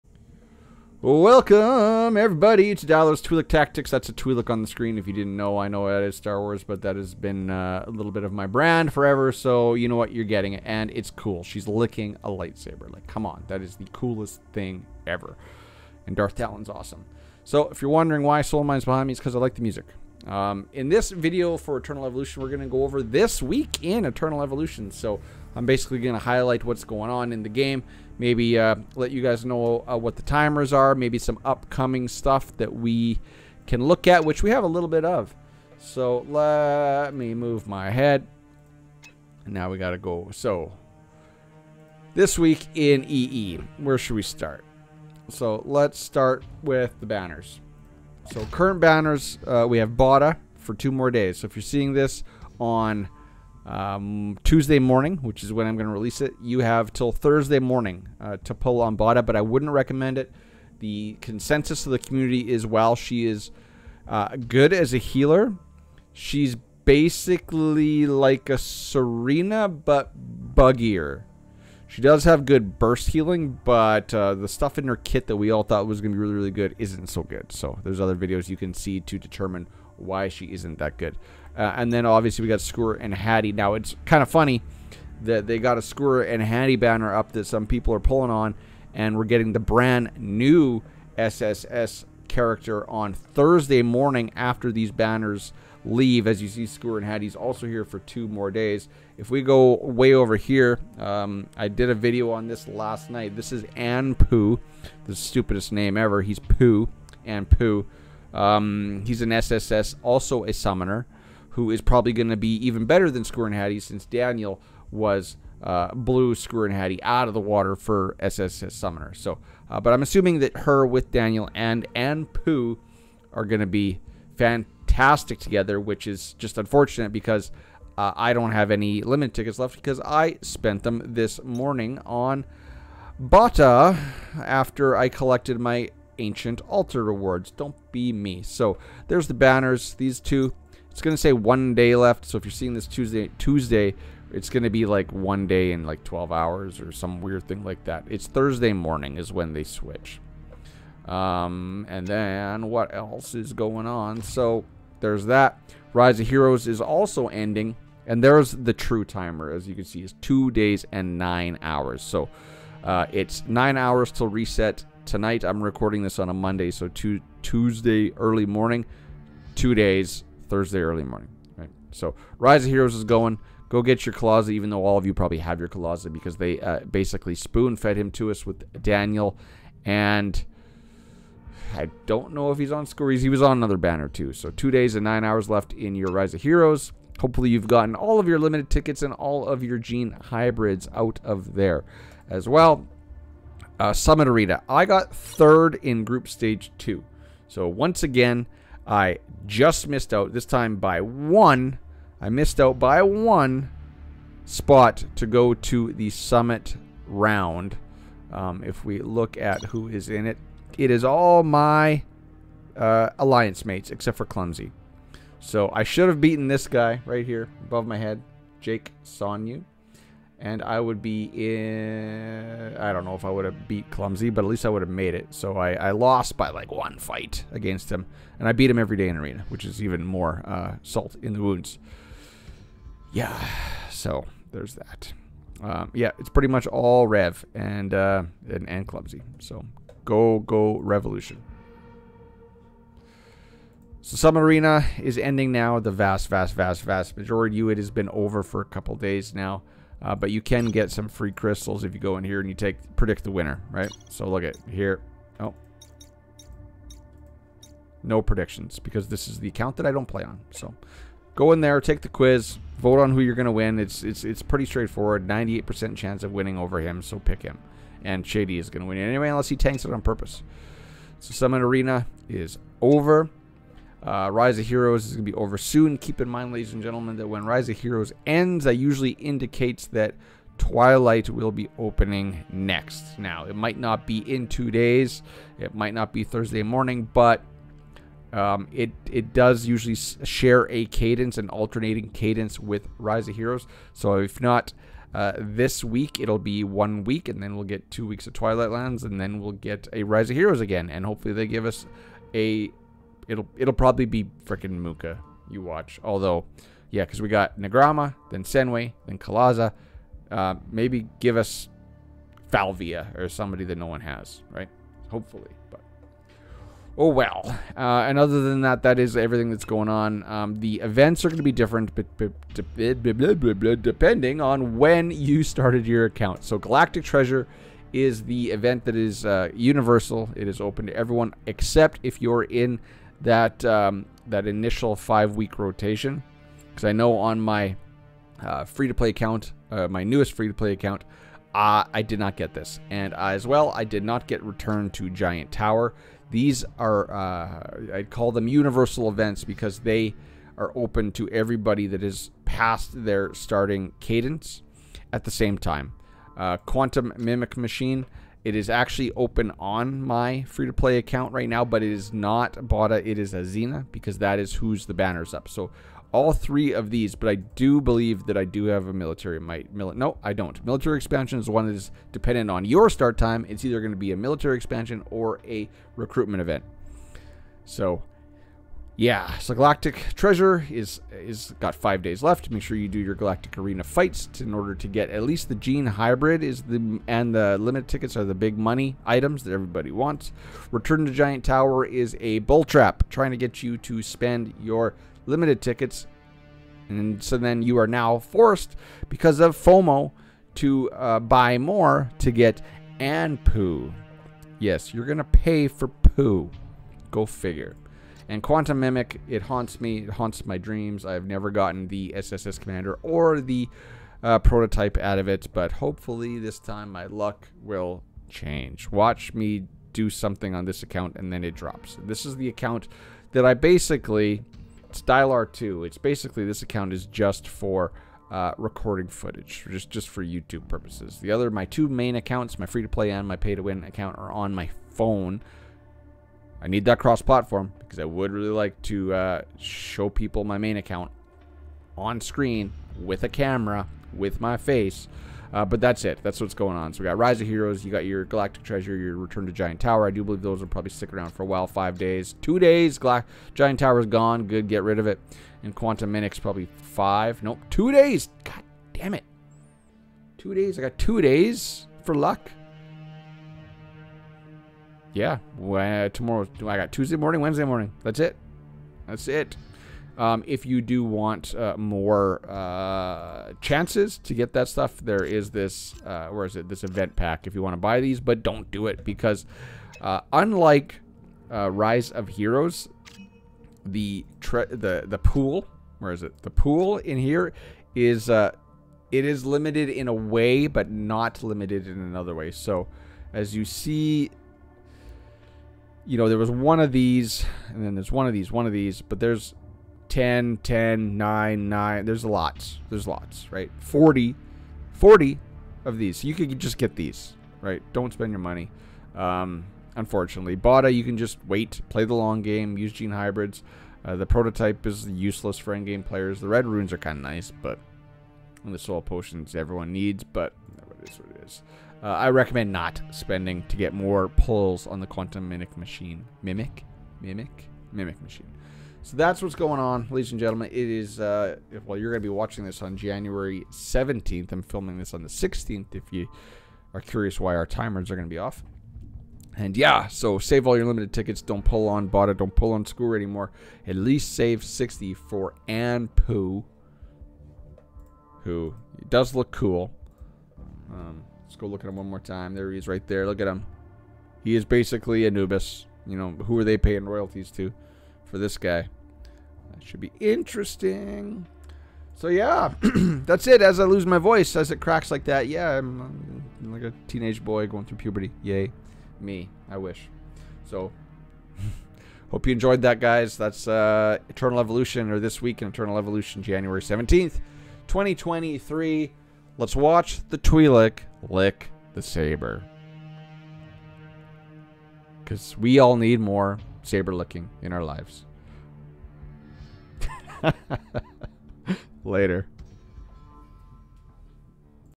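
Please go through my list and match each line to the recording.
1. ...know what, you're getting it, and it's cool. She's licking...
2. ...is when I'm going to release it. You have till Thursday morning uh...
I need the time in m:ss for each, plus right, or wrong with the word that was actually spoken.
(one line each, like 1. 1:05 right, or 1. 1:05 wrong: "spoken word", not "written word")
1. 0:09 right
2. 0:55 right.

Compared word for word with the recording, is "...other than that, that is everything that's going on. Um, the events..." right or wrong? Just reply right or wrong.
right.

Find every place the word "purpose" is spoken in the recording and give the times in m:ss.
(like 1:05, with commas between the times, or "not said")
4:30, 7:10.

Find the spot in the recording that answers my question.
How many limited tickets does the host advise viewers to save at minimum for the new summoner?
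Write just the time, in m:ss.
9:04.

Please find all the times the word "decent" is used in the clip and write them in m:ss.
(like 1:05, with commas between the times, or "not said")
not said.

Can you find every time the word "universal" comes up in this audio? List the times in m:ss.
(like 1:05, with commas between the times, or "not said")
5:29, 5:48.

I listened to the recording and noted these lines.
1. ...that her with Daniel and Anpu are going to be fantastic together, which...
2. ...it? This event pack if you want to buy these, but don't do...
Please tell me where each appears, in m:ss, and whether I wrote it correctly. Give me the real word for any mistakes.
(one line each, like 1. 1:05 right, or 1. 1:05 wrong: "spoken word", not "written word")
1. 2:00 right
2. 7:56 right.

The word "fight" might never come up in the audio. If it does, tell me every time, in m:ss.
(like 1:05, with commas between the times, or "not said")
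3:46, 6:23.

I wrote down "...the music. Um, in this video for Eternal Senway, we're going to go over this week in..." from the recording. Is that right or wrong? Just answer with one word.
wrong.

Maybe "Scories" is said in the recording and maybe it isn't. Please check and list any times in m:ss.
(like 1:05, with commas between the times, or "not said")
3:02.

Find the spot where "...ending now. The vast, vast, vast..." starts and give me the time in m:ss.
4:05.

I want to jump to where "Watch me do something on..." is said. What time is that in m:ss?
6:58.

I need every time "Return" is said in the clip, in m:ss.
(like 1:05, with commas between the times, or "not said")
5:44, 6:30, 7:29.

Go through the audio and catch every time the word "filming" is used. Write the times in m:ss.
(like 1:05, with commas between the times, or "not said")
8:54.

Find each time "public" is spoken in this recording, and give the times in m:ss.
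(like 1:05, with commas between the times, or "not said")
not said.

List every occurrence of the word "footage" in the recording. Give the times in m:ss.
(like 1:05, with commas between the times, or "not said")
7:09.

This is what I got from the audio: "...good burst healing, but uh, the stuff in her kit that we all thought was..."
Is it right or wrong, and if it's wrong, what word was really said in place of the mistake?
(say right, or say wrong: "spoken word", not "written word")
right.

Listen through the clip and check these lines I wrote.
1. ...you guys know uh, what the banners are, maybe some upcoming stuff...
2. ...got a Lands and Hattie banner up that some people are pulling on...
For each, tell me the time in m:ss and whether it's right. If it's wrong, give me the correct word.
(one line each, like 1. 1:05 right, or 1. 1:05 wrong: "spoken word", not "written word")
1. 0:29 wrong: "timers", not "banners"
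2. 1:25 wrong: "Skewer", not "Lands".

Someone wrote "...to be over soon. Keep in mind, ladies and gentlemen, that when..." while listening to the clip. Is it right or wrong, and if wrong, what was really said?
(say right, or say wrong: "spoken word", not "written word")
right.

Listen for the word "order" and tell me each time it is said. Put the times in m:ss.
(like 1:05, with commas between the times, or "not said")
6:24.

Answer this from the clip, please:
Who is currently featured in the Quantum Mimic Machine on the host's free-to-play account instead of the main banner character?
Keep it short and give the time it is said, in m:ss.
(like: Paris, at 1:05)
Azina, at 6:03.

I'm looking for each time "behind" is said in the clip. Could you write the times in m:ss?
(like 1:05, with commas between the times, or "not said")
0:18.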